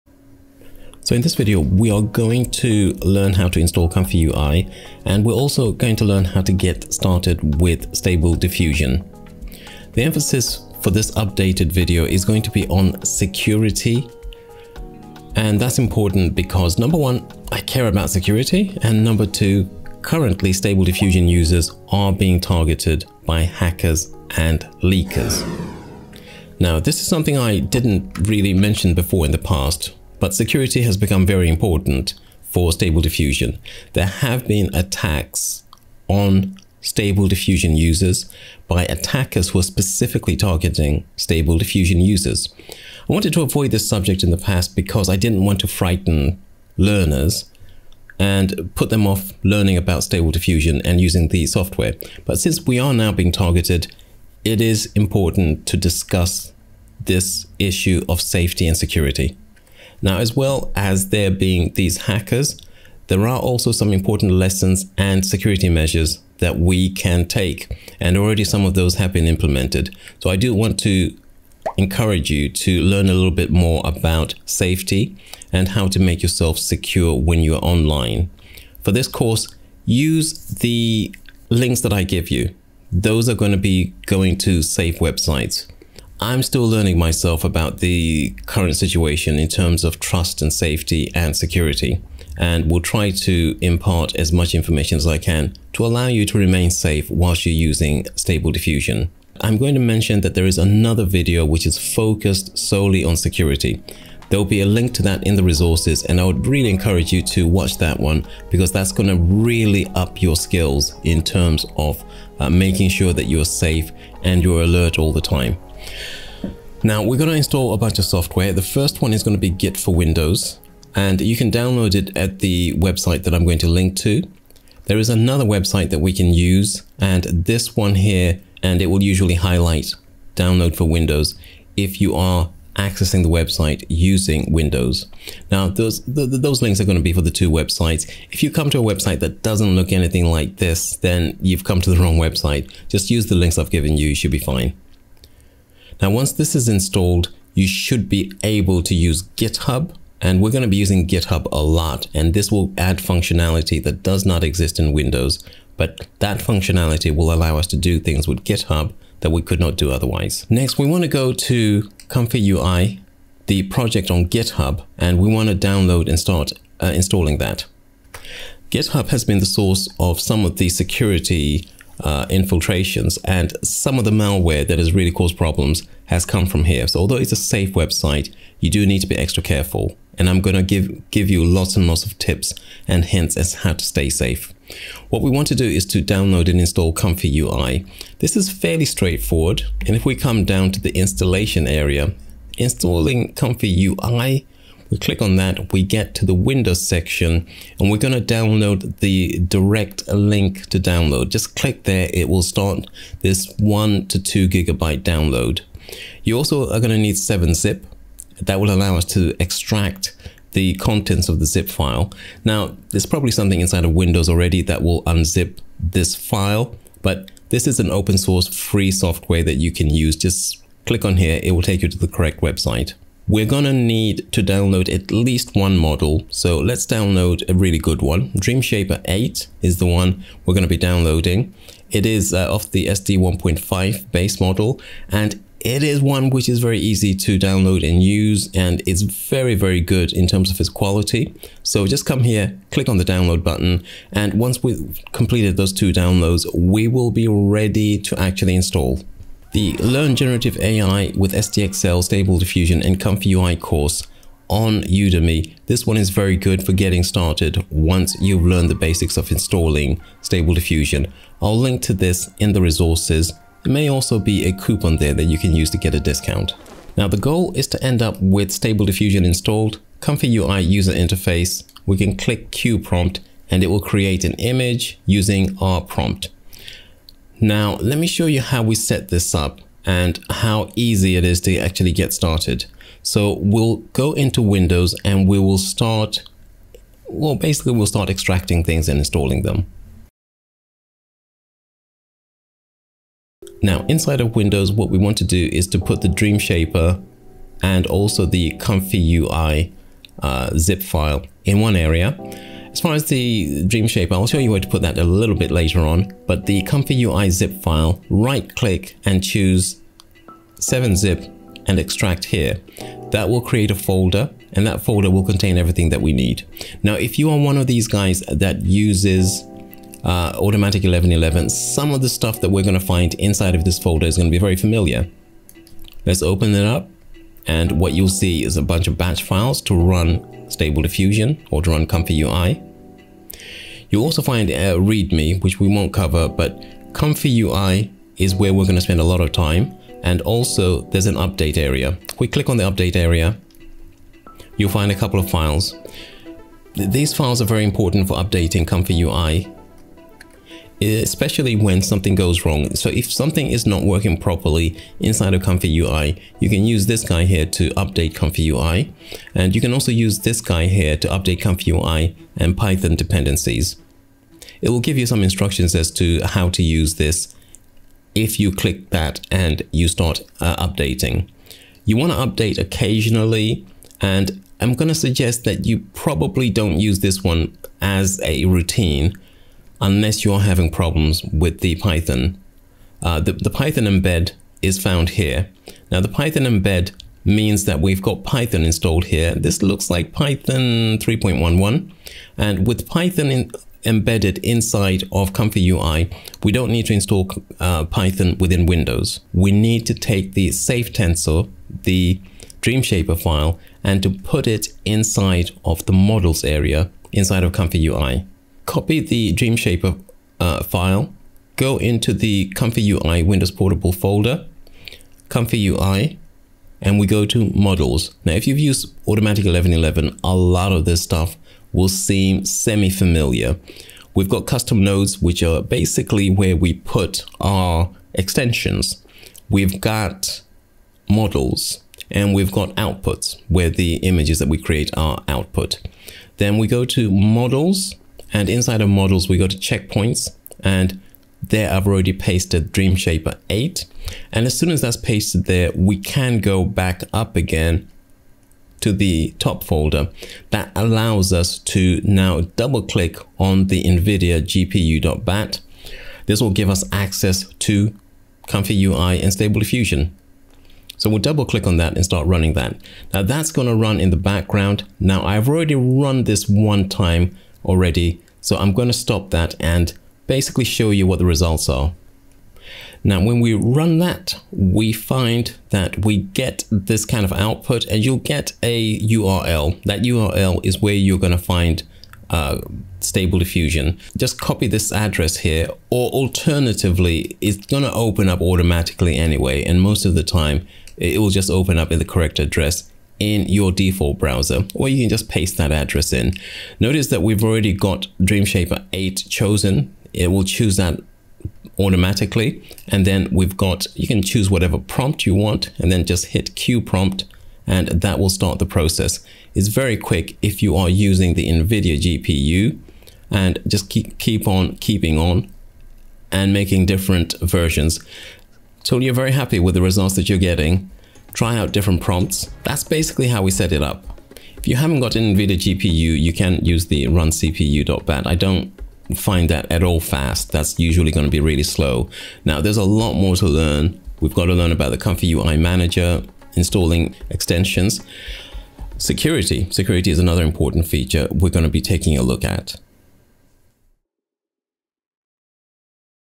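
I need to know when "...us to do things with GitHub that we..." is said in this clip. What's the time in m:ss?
2:37.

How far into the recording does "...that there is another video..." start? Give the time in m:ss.
1:40.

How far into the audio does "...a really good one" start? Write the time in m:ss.
3:47.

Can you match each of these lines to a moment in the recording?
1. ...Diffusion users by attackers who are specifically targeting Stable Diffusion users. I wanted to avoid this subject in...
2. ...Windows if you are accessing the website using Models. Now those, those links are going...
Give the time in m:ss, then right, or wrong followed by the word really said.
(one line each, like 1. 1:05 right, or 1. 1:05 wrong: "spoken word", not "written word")
1. 0:37 right
2. 2:10 wrong: "Windows", not "Models".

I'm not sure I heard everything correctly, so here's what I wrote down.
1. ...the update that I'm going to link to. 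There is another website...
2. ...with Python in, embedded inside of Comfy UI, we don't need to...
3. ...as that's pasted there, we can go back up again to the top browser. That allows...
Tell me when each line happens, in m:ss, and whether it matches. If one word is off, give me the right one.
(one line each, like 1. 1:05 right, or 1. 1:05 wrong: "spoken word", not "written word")
1. 2:02 wrong: "website", not "update"
2. 6:32 right
3. 7:24 wrong: "folder", not "browser".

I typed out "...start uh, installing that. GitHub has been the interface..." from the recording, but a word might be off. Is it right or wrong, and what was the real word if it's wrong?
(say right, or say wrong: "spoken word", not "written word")
wrong: "source", not "interface".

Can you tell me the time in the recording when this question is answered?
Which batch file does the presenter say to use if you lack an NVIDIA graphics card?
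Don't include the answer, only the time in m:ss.
8:47.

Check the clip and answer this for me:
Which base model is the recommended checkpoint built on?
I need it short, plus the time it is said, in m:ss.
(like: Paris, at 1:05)
SD 1.5, at 3:52.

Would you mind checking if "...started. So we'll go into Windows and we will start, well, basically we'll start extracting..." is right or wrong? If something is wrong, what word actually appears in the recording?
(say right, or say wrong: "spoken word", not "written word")
right.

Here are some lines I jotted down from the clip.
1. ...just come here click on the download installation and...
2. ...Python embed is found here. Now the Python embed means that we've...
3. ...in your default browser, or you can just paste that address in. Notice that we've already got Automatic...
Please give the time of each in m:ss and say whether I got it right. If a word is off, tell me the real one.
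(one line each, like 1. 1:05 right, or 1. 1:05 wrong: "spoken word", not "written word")
1. 4:01 wrong: "button", not "installation"
2. 6:23 right
3. 8:13 wrong: "DreamShaper", not "Automatic".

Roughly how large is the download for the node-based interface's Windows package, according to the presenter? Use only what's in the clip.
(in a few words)
1 to 2 gigabytes.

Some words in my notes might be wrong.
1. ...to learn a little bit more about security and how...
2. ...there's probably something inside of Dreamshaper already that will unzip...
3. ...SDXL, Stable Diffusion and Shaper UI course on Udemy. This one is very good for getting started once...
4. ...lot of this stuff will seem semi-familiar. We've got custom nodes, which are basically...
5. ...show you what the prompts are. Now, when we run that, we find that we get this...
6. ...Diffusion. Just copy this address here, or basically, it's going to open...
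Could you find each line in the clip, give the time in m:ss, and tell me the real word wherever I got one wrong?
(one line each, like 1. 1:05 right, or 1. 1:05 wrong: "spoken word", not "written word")
1. 1:12 wrong: "safety", not "security"
2. 3:32 wrong: "Windows", not "Dreamshaper"
3. 4:11 wrong: "Comfy", not "Shaper"
4. 7:00 right
5. 7:50 wrong: "results", not "prompts"
6. 8:03 wrong: "alternatively", not "basically".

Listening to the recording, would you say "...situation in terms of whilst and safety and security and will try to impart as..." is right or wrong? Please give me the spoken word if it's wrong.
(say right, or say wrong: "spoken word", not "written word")
wrong: "trust", not "whilst".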